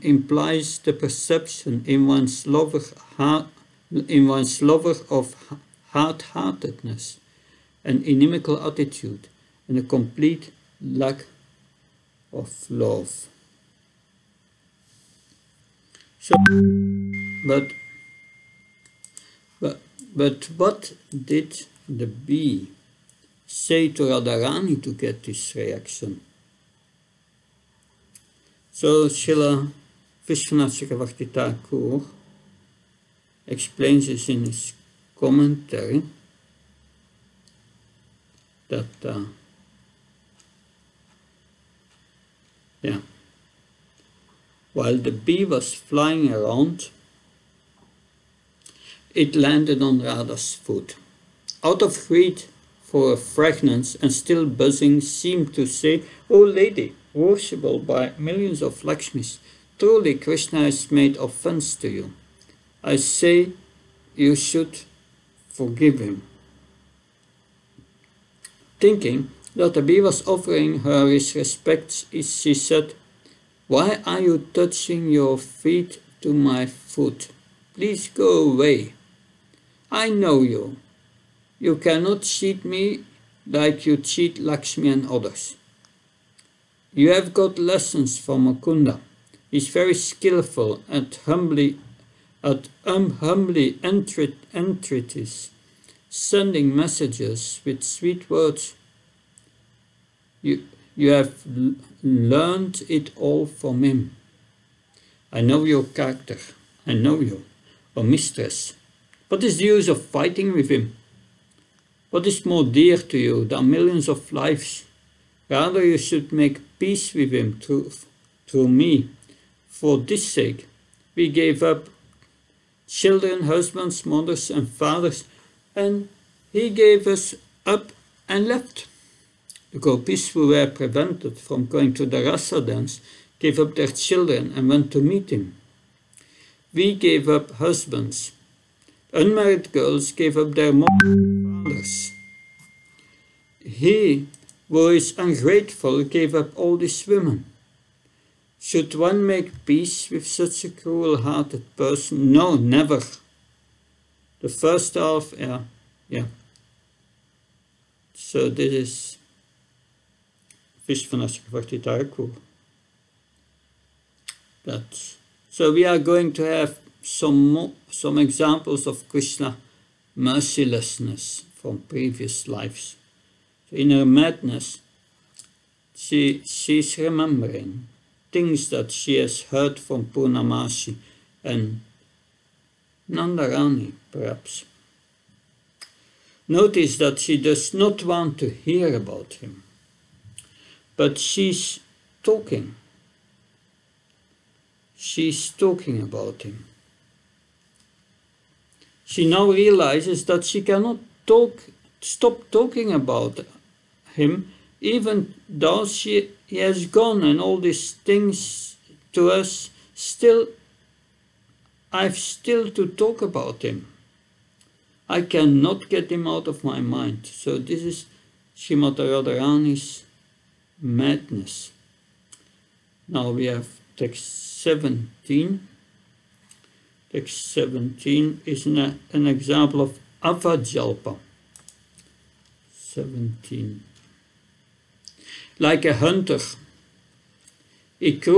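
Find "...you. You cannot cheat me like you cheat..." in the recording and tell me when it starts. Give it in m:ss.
1:20.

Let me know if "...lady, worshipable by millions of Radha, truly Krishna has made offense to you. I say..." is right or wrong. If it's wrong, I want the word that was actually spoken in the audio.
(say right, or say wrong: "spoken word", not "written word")
wrong: "Lakshmis", not "Radha".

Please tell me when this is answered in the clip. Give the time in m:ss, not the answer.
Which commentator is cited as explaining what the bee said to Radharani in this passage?
0:30.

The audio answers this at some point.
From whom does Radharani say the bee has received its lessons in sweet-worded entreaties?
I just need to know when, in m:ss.
1:28.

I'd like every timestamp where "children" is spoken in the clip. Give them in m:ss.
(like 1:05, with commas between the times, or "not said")
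2:02, 2:13.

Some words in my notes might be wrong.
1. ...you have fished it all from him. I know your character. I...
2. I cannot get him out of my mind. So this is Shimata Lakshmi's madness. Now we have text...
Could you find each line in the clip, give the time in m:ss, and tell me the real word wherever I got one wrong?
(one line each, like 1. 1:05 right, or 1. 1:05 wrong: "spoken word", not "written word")
1. 1:40 wrong: "learned", not "fished"
2. 3:35 wrong: "Radharani", not "Lakshmi".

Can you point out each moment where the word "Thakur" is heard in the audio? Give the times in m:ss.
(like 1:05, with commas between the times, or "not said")
2:41.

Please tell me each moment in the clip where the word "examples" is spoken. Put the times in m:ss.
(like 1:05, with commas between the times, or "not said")
2:48, 3:49.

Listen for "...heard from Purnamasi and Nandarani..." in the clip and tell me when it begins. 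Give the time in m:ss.
2:59.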